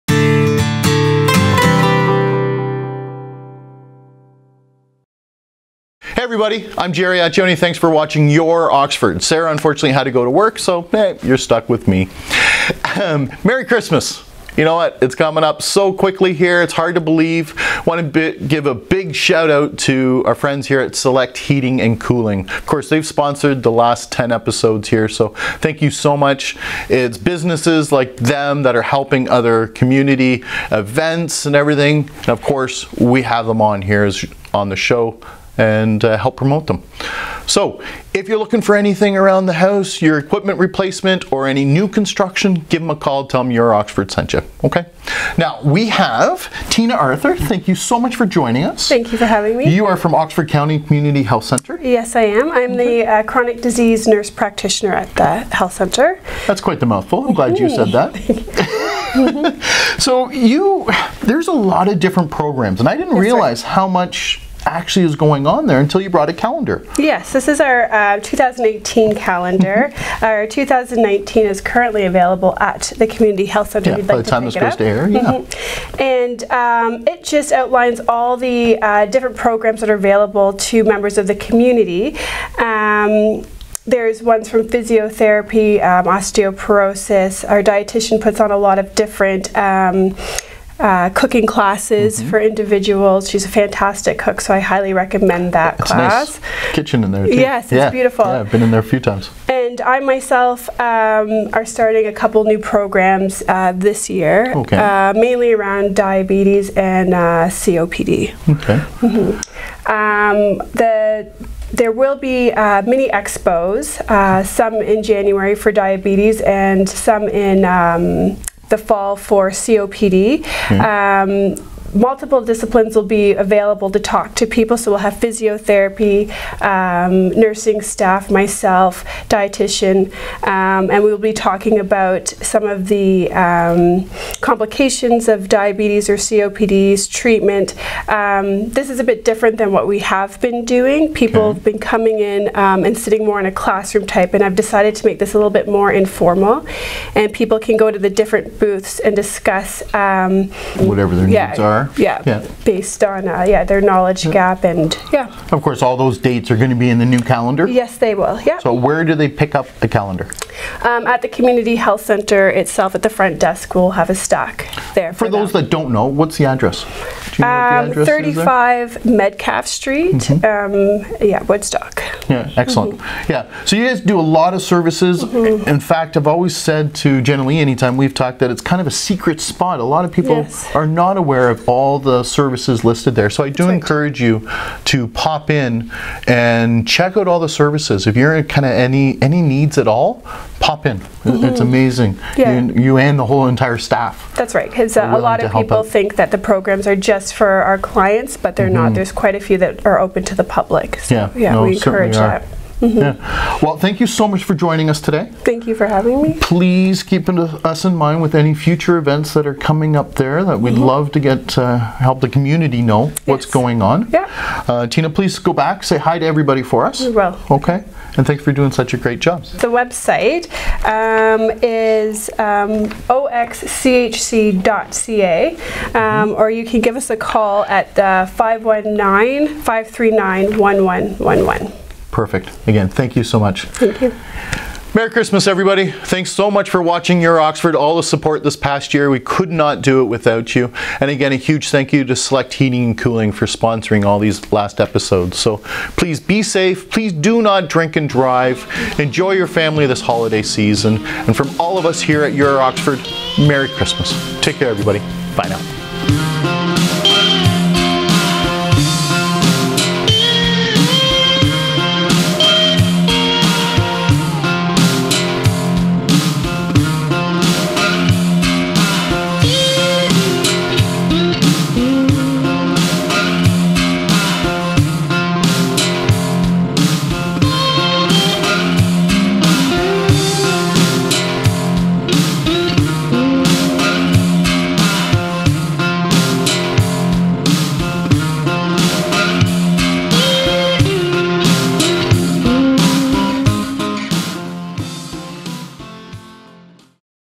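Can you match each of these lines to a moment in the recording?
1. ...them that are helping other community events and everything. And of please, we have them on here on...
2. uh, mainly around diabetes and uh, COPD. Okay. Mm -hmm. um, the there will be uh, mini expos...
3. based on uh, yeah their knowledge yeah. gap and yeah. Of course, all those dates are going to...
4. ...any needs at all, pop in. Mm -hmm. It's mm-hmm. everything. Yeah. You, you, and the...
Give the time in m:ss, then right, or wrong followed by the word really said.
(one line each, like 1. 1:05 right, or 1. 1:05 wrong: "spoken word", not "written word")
1. 0:28 wrong: "course", not "please"
2. 1:44 right
3. 2:32 right
4. 3:09 wrong: "amazing", not "everything".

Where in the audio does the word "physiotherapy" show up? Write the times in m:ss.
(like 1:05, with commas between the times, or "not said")
1:24, 2:05.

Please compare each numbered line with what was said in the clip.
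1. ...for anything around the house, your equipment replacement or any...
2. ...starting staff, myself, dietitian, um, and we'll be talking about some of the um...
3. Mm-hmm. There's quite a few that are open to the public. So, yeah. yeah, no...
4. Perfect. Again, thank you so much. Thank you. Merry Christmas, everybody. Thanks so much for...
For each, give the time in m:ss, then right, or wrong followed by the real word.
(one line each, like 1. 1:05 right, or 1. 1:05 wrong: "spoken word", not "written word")
1. 0:38 right
2. 2:07 wrong: "nursing", not "starting"
3. 3:18 right
4. 3:52 right.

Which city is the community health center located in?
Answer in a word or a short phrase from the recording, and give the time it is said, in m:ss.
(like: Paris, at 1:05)
Woodstock, at 2:51.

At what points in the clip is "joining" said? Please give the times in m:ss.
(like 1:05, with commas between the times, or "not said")
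0:48, 3:24.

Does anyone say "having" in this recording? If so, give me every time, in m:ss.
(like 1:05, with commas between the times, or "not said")
0:49, 3:25.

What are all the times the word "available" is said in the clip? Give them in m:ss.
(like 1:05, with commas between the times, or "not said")
1:12, 1:20, 2:03.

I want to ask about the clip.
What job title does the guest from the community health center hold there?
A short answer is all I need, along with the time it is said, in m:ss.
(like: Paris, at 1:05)
Chronic disease nurse practitioner, at 0:53.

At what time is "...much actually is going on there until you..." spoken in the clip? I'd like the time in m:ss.
1:03.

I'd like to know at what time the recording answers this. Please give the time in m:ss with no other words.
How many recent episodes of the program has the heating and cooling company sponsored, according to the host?
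0:24.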